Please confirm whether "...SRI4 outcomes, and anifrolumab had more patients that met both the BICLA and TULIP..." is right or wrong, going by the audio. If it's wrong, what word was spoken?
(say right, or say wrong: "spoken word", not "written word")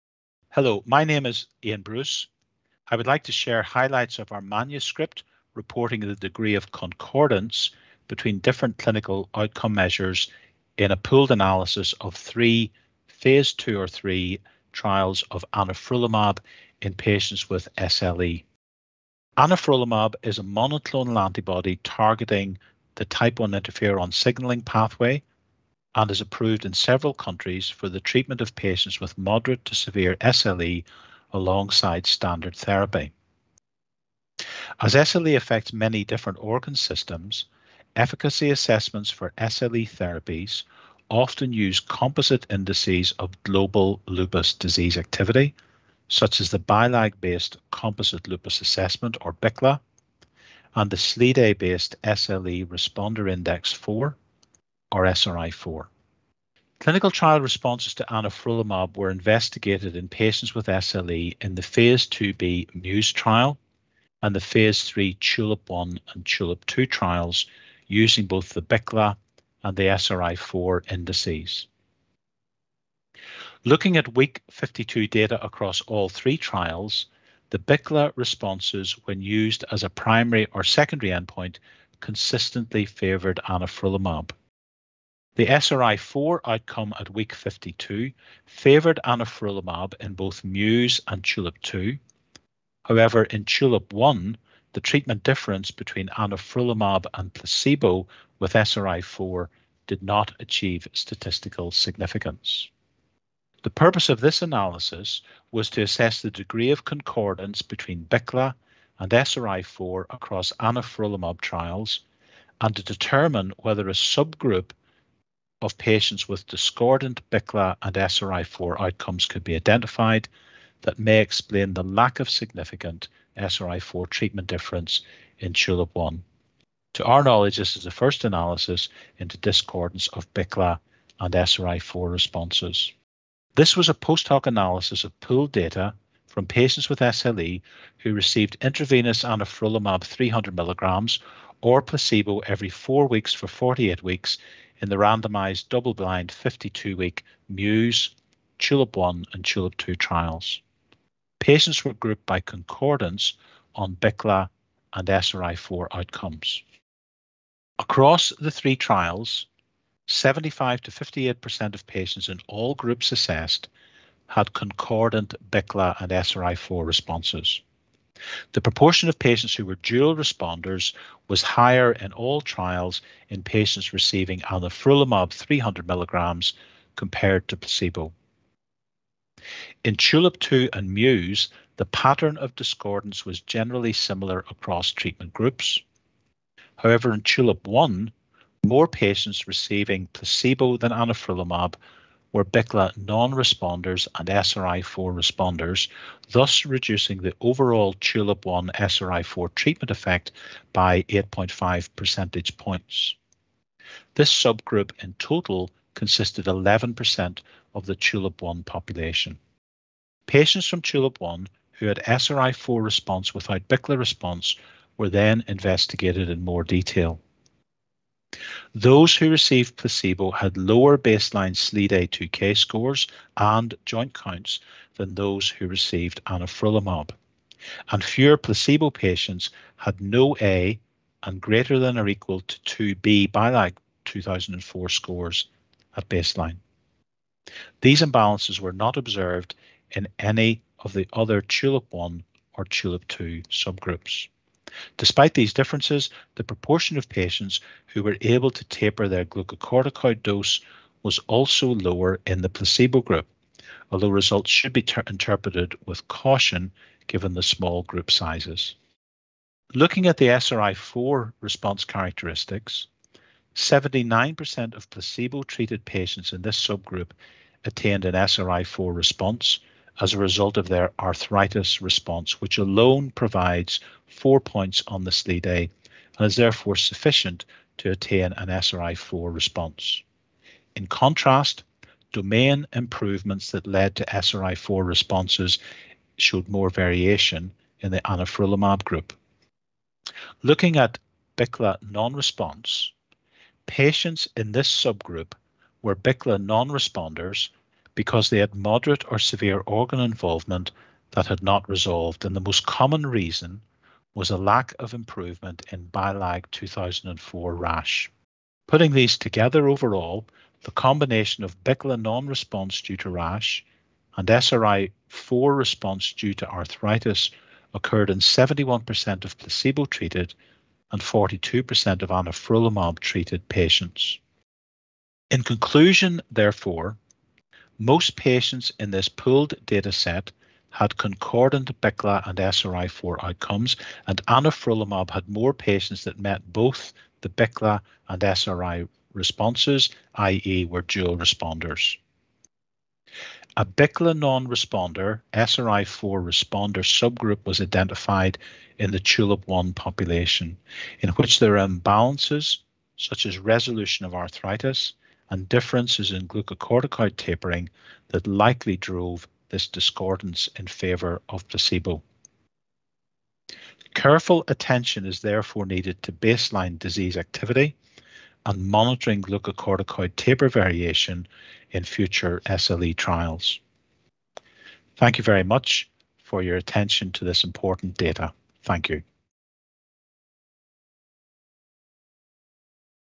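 wrong: "SRI", not "TULIP".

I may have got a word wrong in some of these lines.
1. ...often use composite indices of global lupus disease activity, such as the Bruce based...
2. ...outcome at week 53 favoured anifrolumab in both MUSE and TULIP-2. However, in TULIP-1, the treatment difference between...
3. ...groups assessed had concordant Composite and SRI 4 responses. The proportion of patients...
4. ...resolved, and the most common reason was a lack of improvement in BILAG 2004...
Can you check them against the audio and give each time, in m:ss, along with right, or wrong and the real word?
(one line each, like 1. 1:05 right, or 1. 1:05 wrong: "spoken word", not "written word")
1. 0:41 wrong: "BILAG", not "Bruce"
2. 1:26 wrong: "52", not "53"
3. 2:42 wrong: "BICLA", not "Composite"
4. 5:01 right.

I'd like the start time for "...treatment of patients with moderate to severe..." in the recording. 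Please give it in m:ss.
0:27.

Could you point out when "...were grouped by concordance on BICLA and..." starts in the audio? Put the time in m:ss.
2:31.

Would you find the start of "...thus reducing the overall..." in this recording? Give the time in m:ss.
3:16.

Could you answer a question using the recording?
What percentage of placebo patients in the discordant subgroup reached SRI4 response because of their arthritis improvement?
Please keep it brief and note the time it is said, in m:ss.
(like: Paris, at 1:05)
79%, at 4:23.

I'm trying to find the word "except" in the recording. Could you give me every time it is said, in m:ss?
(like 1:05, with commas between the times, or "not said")
not said.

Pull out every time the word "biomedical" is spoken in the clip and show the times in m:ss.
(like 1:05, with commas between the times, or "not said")
not said.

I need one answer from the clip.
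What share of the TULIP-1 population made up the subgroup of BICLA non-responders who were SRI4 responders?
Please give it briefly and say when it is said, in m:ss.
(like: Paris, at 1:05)
11%, at 3:26.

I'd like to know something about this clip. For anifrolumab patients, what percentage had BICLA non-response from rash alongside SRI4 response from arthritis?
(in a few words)
42%.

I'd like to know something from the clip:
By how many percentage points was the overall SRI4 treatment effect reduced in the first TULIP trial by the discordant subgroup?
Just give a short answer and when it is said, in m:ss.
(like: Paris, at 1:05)
8.5, at 3:21.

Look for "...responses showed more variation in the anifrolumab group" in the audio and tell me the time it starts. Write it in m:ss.
4:44.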